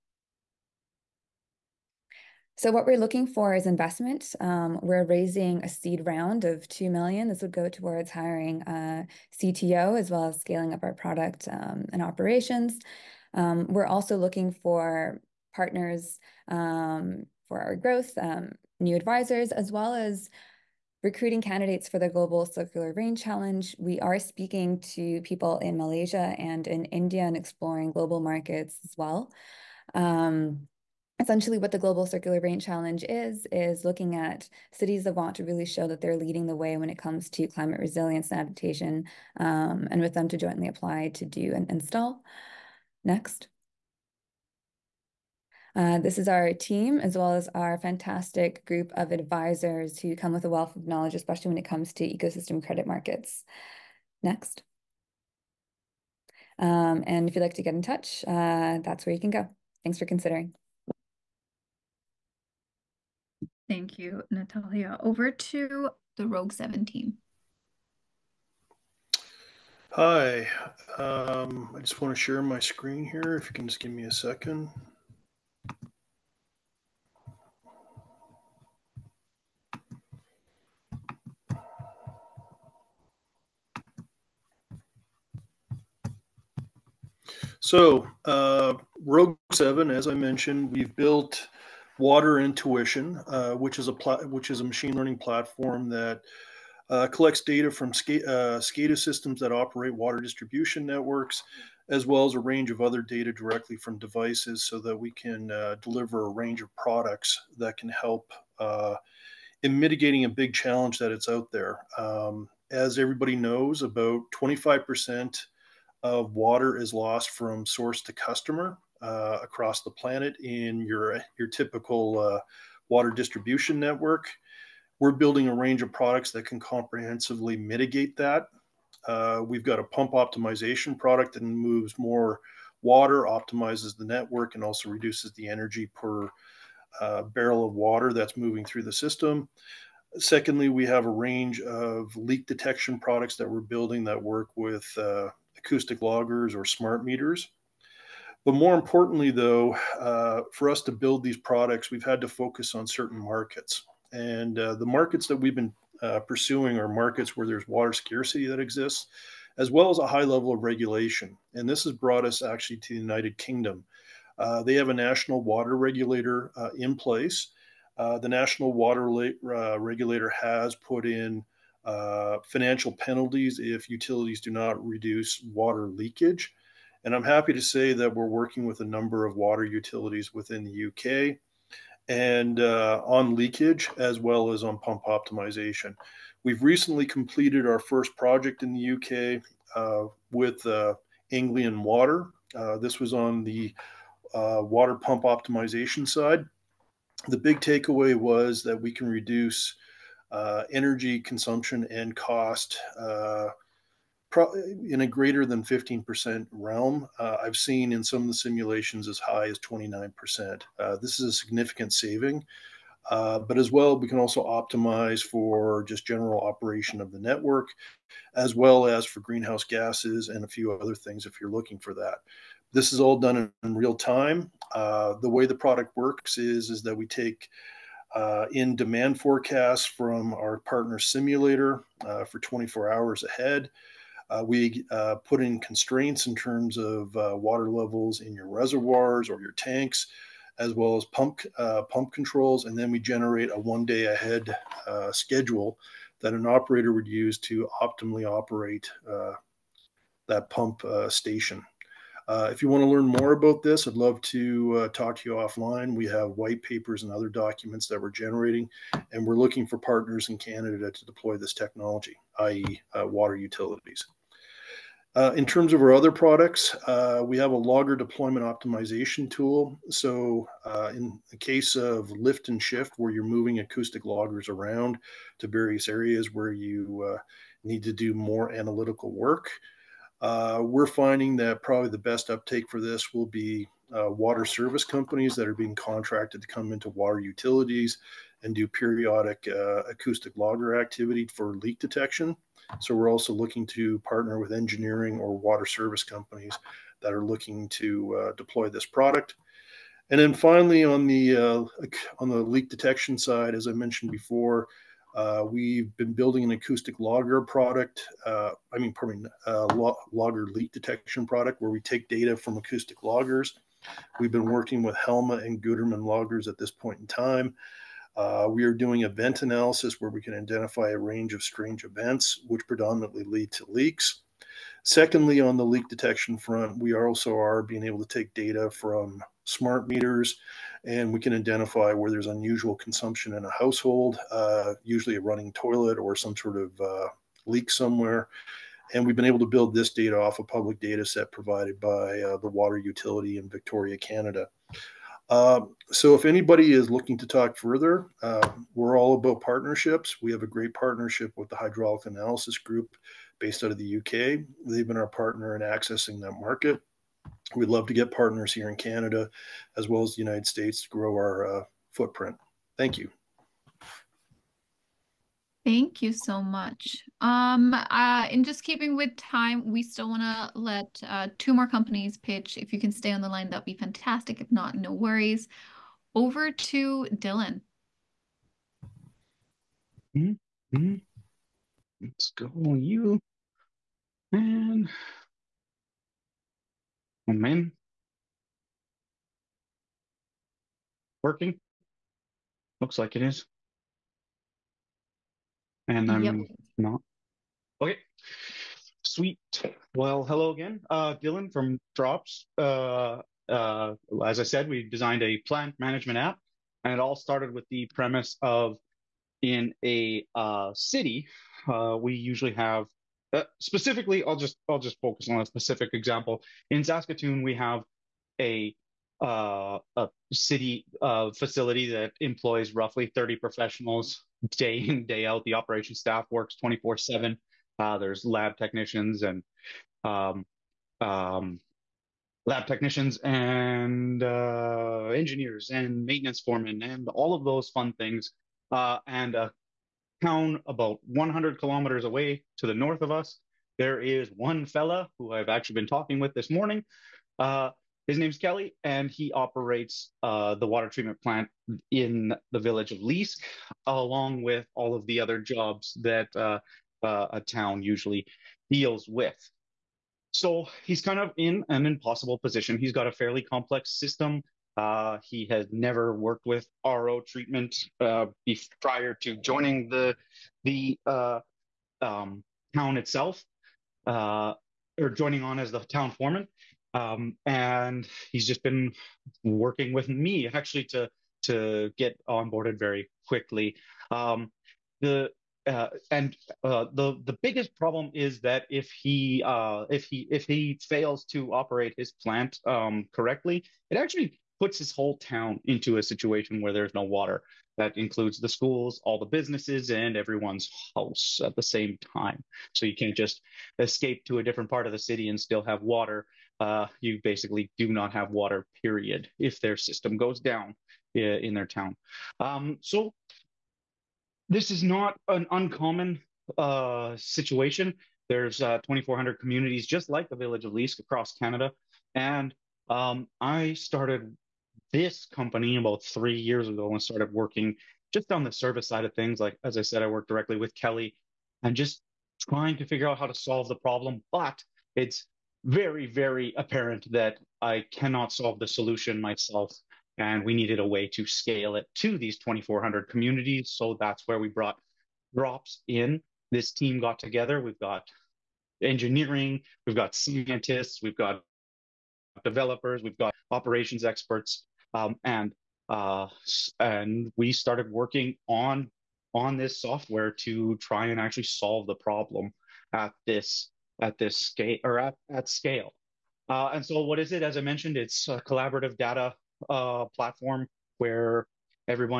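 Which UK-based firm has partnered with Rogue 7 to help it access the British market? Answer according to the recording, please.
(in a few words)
Hydraulic Analysis Group.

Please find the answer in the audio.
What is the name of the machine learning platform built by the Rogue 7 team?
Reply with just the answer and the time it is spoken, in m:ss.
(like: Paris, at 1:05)
Water Intuition, at 1:32.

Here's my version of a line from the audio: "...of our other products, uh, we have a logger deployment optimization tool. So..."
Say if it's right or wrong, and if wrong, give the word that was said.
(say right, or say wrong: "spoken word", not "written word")
right.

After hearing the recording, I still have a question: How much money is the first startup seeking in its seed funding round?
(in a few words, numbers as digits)
2 million.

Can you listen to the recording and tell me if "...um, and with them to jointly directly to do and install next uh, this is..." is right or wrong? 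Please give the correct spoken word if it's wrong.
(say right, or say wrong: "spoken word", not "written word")
wrong: "apply", not "directly".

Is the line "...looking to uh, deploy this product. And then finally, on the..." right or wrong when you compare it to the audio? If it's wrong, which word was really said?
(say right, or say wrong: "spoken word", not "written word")
right.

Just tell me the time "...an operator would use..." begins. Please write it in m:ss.
4:06.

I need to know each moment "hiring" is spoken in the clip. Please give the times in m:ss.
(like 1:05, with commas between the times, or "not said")
0:08.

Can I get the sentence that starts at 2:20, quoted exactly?
Secondly, we have a range of leak detection products that we're building that work with uh, acoustic loggers or smart meters.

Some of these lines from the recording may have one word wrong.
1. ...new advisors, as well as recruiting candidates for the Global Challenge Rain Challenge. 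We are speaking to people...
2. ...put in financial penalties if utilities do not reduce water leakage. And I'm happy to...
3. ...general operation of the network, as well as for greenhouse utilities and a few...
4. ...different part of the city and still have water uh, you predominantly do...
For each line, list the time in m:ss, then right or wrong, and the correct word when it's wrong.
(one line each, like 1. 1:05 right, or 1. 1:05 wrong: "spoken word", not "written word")
1. 0:18 wrong: "Circular", not "Challenge"
2. 2:50 right
3. 3:36 wrong: "gases", not "utilities"
4. 8:24 wrong: "basically", not "predominantly".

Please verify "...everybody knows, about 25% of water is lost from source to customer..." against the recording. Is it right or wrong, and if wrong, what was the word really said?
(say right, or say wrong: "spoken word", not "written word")
right.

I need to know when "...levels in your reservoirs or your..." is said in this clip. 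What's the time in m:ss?
3:57.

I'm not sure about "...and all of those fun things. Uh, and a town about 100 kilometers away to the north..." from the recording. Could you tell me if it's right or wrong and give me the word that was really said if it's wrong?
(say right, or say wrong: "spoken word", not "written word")
right.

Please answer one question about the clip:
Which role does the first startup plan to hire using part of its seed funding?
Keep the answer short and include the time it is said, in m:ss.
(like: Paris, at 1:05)
CTO, at 0:09.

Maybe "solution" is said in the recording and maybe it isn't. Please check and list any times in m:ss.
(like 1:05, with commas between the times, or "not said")
8:58.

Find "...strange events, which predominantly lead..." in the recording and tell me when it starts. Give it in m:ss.
5:21.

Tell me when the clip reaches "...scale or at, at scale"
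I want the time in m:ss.
9:24.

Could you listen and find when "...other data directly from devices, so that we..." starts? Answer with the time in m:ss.
1:42.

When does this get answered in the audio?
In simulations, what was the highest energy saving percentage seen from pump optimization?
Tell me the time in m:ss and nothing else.
3:29.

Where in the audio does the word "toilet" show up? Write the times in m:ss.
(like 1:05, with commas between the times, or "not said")
5:35.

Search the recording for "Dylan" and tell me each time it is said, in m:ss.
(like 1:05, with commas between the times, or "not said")
6:17, 6:41.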